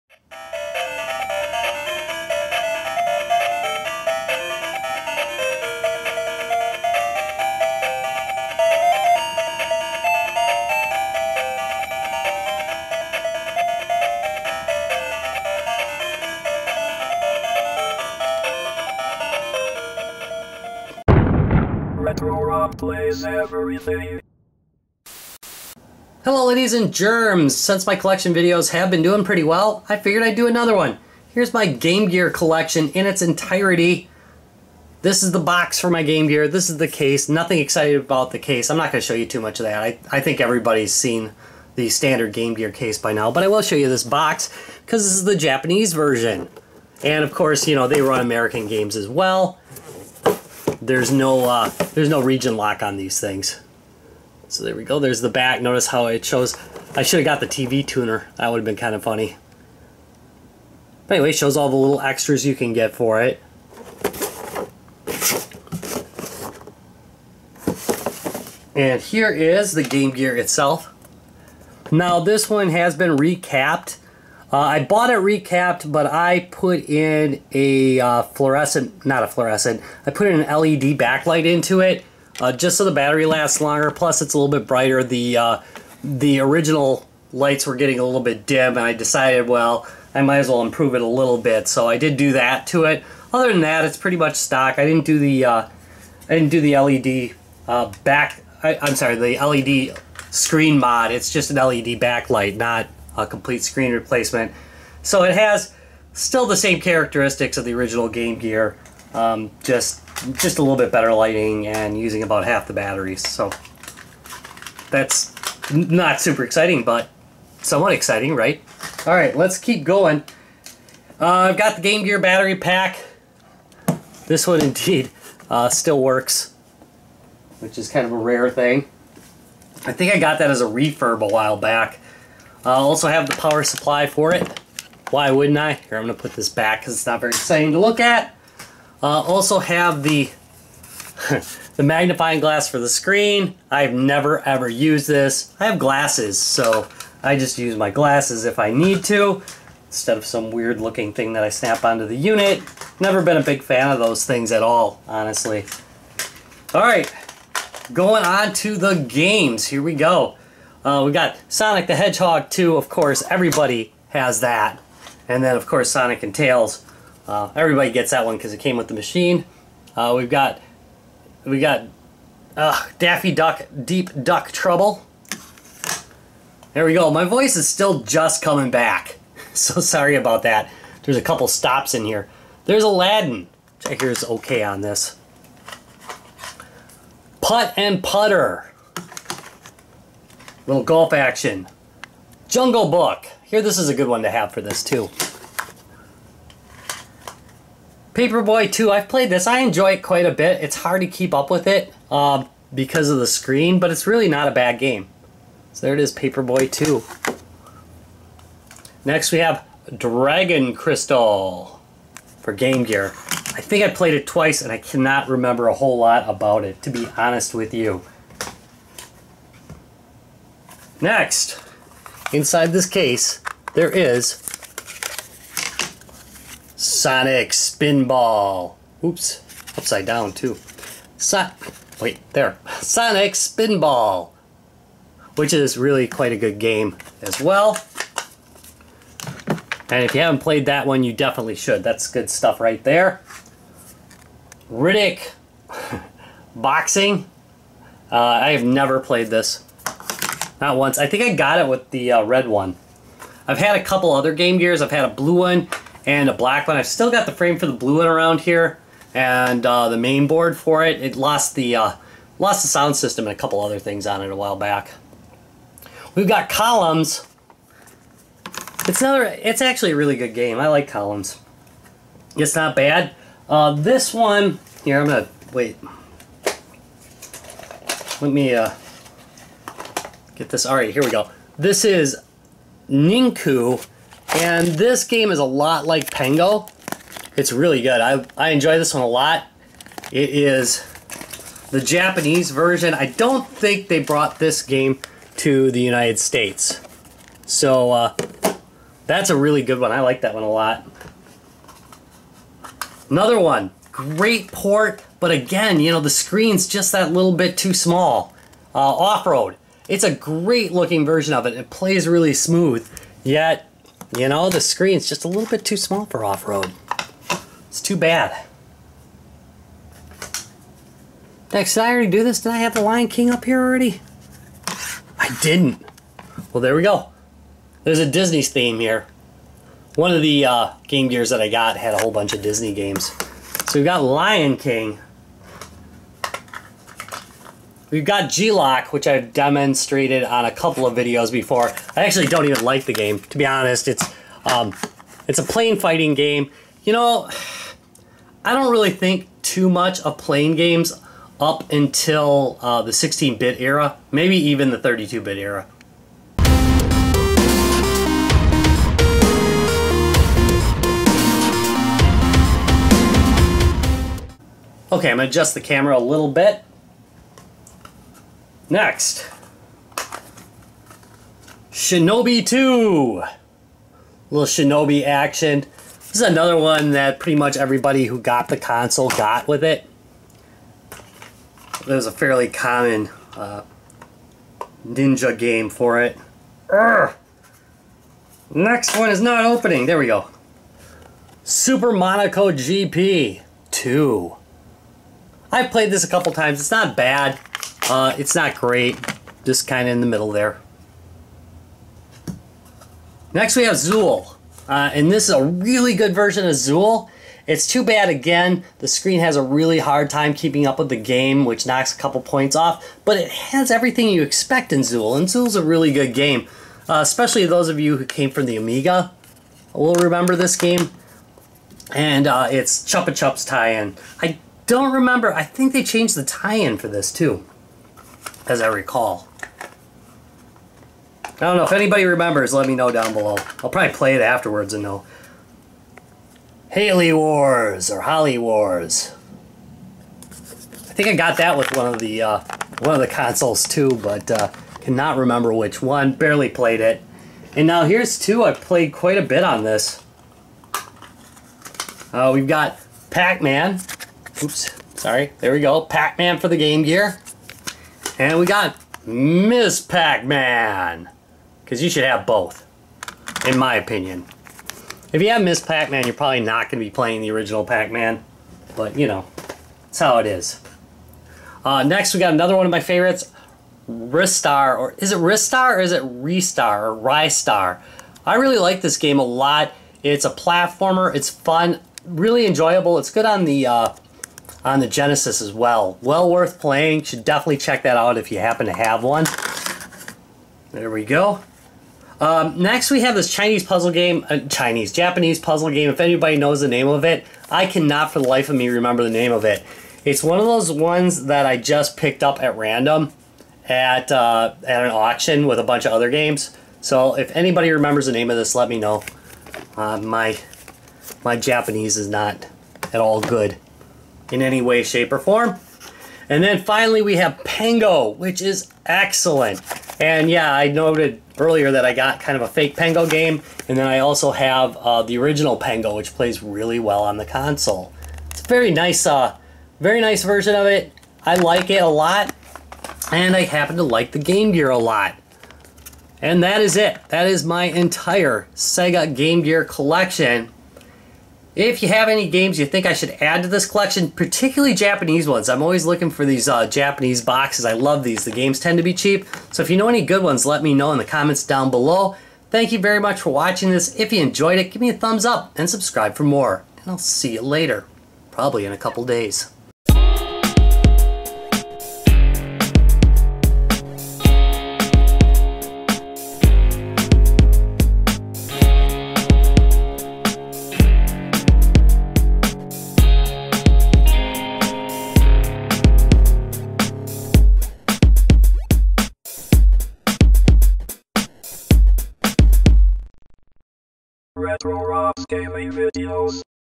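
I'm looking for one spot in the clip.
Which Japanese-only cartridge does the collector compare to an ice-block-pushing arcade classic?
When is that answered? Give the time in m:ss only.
4:42.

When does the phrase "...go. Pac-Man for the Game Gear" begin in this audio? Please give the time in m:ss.
7:35.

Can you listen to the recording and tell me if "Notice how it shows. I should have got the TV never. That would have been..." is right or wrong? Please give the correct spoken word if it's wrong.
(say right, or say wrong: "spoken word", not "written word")
wrong: "tuner", not "never".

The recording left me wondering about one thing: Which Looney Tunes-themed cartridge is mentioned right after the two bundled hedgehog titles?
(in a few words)
Daffy Duck Deep Duck Trouble.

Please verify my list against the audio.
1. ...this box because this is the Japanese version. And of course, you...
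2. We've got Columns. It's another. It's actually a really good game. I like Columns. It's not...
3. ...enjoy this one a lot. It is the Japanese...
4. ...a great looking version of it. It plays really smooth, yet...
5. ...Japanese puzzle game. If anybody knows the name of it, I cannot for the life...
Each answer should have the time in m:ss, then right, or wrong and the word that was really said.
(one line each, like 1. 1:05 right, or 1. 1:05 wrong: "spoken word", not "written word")
1. 0:43 right
2. 4:26 right
3. 4:48 right
4. 5:10 right
5. 8:14 right.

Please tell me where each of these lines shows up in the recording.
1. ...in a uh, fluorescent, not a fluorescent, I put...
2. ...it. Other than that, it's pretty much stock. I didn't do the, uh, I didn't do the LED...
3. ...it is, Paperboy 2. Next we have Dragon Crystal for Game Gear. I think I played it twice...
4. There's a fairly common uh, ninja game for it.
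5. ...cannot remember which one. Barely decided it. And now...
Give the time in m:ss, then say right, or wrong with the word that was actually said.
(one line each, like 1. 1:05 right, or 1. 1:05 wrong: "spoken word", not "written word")
1. 1:16 right
2. 1:32 right
3. 3:25 right
4. 6:21 right
5. 7:24 wrong: "played", not "decided".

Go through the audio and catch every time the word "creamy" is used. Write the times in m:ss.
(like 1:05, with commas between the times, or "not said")
not said.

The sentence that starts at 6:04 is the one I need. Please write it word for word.
Okay, I'm gonna adjust the camera a little bit.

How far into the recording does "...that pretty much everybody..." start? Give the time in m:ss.
6:16.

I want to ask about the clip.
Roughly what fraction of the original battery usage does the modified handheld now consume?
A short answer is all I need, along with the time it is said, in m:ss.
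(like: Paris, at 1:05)
half, at 1:52.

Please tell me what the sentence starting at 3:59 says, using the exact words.
And if you haven't played that one, you definitely should.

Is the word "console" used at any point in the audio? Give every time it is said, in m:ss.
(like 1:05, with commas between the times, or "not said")
6:18, 7:23, 8:47.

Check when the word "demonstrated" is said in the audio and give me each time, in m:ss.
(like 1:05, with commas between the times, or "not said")
5:39.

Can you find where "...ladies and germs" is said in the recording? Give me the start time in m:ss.
0:26.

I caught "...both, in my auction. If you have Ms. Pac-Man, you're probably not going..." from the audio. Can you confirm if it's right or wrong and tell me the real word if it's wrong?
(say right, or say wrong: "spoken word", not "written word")
wrong: "opinion", not "auction".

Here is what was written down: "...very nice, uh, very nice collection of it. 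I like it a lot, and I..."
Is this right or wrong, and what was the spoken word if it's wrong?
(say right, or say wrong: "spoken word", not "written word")
wrong: "version", not "collection".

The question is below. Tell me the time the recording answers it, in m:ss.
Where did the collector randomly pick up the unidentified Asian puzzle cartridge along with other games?
8:24.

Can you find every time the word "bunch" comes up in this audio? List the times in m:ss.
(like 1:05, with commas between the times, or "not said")
5:32, 8:25.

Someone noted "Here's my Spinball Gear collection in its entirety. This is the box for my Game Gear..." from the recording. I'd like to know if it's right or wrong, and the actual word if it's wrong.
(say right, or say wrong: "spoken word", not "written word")
wrong: "Game", not "Spinball".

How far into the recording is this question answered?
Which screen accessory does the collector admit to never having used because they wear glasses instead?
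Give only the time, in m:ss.
2:21.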